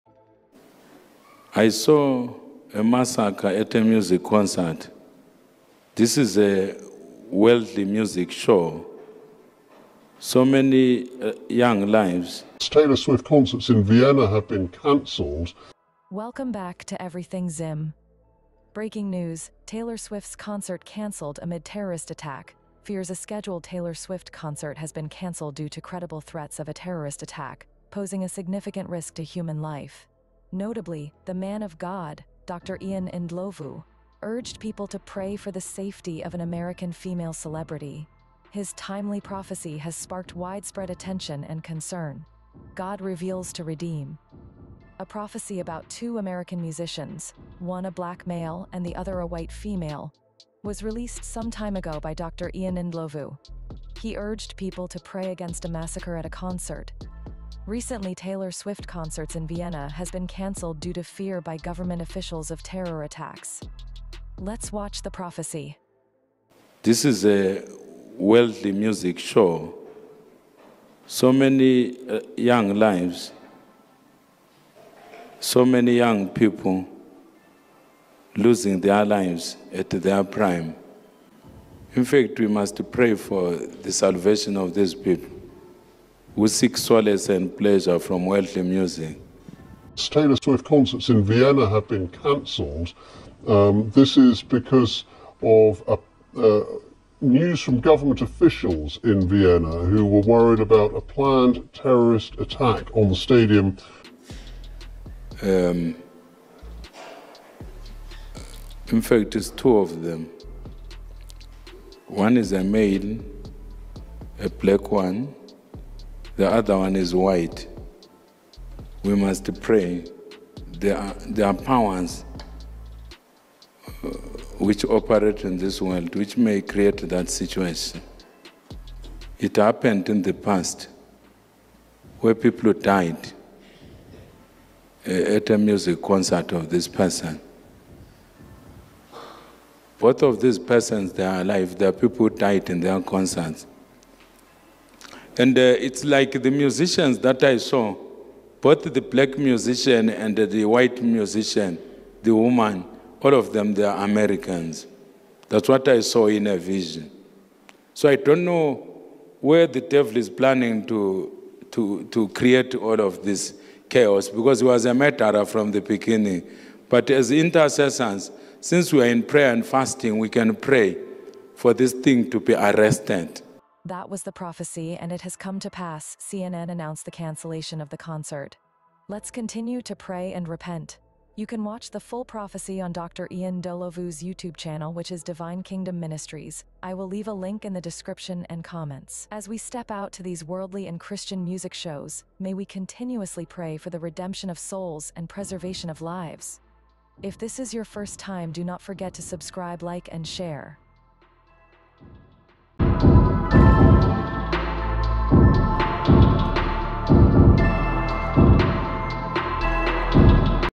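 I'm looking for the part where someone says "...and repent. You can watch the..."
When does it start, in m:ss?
3:00.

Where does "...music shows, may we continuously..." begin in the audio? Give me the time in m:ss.
3:11.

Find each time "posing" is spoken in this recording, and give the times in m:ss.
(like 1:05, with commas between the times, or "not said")
0:27.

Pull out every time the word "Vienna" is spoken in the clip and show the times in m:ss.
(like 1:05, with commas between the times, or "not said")
0:13, 0:59, 1:31, 1:39.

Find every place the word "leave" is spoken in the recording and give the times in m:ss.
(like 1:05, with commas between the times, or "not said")
3:07.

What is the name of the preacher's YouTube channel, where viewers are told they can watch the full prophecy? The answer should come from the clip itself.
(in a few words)
Divine Kingdom Ministries.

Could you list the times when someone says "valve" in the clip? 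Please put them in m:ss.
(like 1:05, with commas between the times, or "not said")
not said.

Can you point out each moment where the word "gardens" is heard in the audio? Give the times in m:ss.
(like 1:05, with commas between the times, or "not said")
not said.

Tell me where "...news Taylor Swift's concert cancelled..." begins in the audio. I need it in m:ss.
0:19.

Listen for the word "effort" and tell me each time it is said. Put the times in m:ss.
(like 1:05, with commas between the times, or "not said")
not said.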